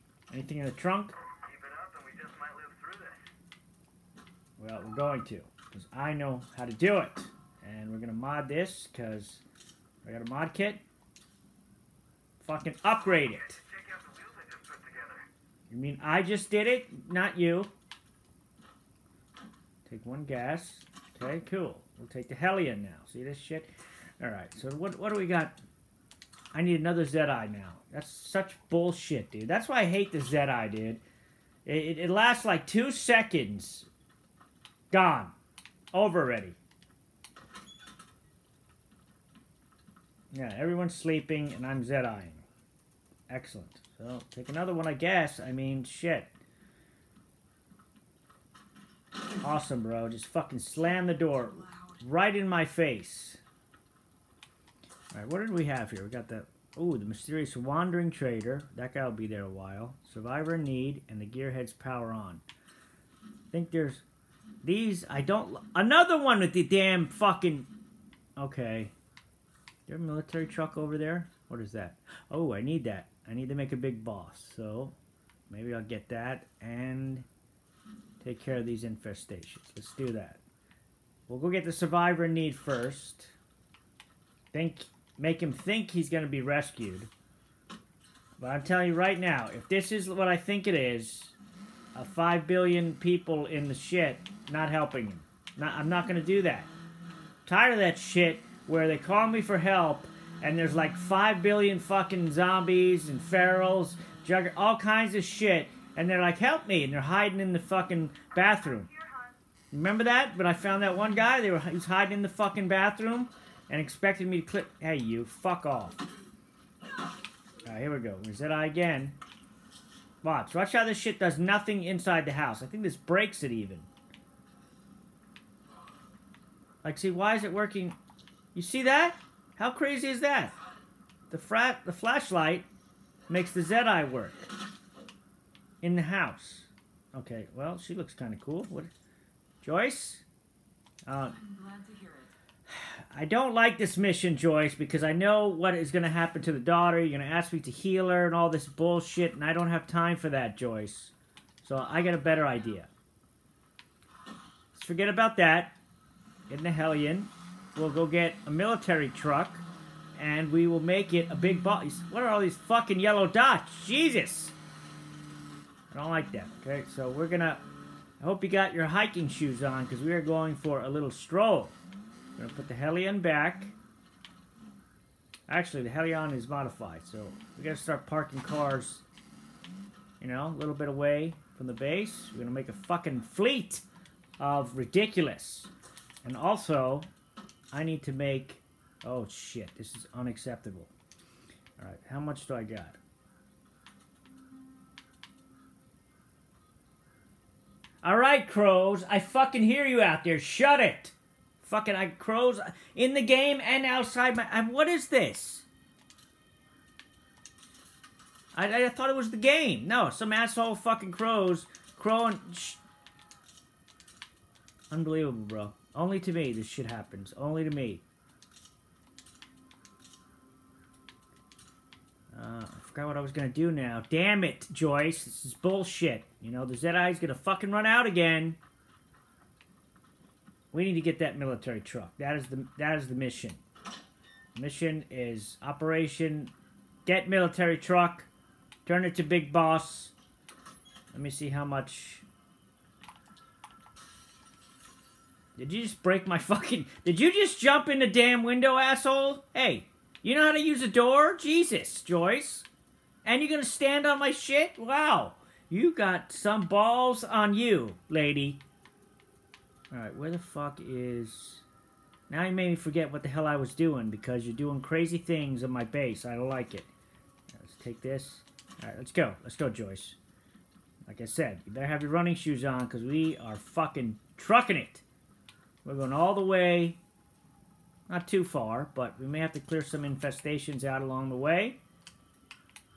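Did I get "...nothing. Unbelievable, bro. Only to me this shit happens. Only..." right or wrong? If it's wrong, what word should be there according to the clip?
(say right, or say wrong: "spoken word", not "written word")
wrong: "crowing", not "nothing".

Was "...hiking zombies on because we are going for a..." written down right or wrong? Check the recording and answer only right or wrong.
wrong.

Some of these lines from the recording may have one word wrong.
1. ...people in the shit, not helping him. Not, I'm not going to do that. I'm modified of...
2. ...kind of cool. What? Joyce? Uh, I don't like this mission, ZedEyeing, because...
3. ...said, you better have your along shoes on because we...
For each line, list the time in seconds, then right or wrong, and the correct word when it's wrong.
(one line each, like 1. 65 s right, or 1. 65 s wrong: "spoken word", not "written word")
1. 92 s wrong: "tired", not "modified"
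2. 138 s wrong: "Joyce", not "ZedEyeing"
3. 271 s wrong: "running", not "along".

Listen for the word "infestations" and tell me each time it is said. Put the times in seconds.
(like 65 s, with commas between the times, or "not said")
78 s, 280 s.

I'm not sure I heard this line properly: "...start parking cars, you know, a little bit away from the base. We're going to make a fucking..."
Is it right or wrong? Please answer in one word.
right.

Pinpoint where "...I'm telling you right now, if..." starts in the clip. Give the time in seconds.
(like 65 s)
88 s.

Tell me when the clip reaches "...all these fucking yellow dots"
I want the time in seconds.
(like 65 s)
162 s.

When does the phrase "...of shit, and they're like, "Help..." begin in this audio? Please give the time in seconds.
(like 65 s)
105 s.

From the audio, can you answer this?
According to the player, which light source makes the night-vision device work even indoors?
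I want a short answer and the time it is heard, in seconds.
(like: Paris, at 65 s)
The flashlight, at 131 s.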